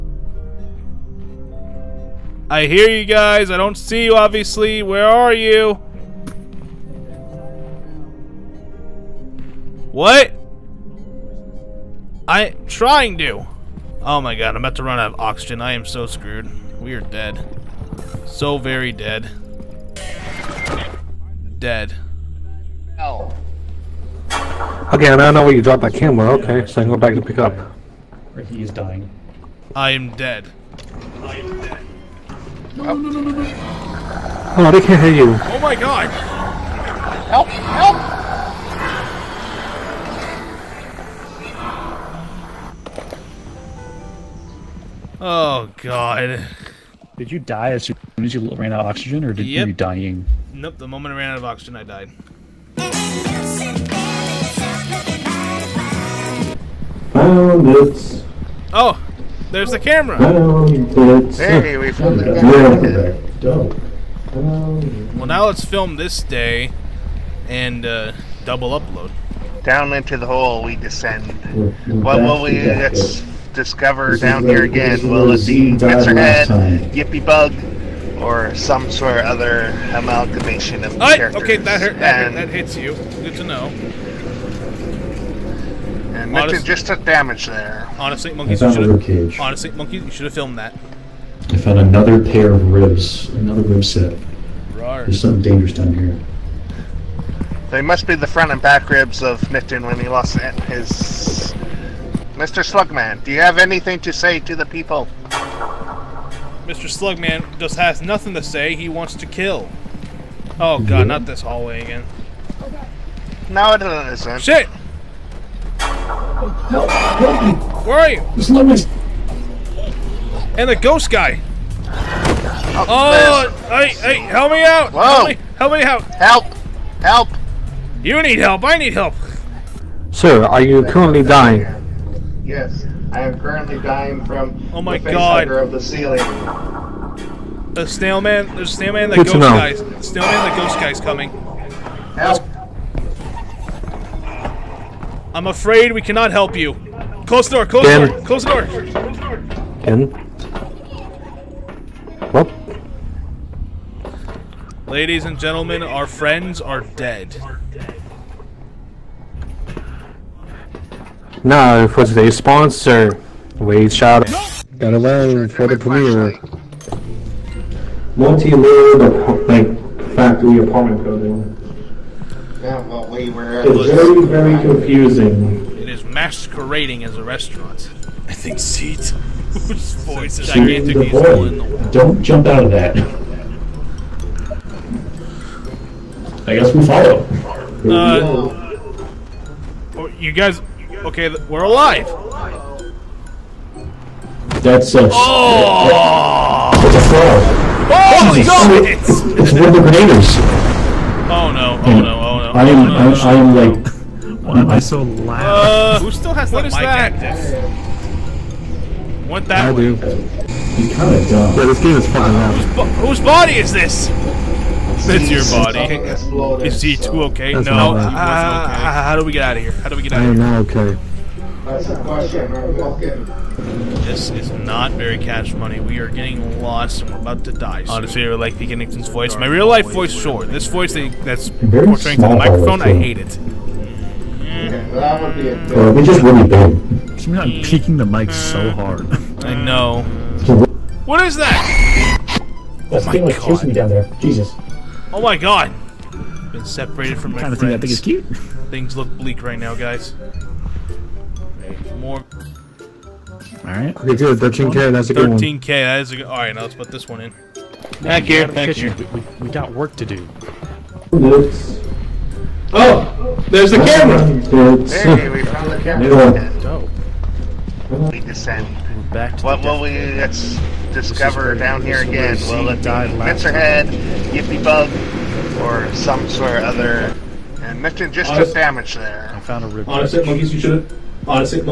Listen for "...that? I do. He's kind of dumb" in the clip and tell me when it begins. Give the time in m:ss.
3:29.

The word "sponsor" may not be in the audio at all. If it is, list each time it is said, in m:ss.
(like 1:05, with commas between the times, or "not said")
2:42.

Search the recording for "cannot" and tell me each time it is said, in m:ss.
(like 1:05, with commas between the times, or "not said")
2:26.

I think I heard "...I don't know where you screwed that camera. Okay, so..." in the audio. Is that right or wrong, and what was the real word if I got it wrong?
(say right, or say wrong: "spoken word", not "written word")
wrong: "dropped", not "screwed".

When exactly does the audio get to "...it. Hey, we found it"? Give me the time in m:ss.
1:00.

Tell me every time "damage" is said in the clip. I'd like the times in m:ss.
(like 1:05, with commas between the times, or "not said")
1:27, 4:38.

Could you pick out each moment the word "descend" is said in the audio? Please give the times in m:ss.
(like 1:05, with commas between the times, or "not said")
1:10, 4:28.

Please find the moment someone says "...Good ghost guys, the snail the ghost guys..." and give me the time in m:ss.
2:19.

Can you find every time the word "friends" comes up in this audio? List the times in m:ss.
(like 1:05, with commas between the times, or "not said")
2:36, 4:07.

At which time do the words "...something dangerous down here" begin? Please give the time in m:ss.
1:35.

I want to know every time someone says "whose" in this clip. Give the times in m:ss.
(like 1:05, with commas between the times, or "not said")
2:59, 3:33.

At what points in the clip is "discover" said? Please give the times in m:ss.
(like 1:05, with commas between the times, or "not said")
1:13, 4:30.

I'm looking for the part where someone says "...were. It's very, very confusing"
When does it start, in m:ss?
2:53.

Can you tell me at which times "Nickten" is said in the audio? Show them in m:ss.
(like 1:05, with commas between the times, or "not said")
1:39, 3:48.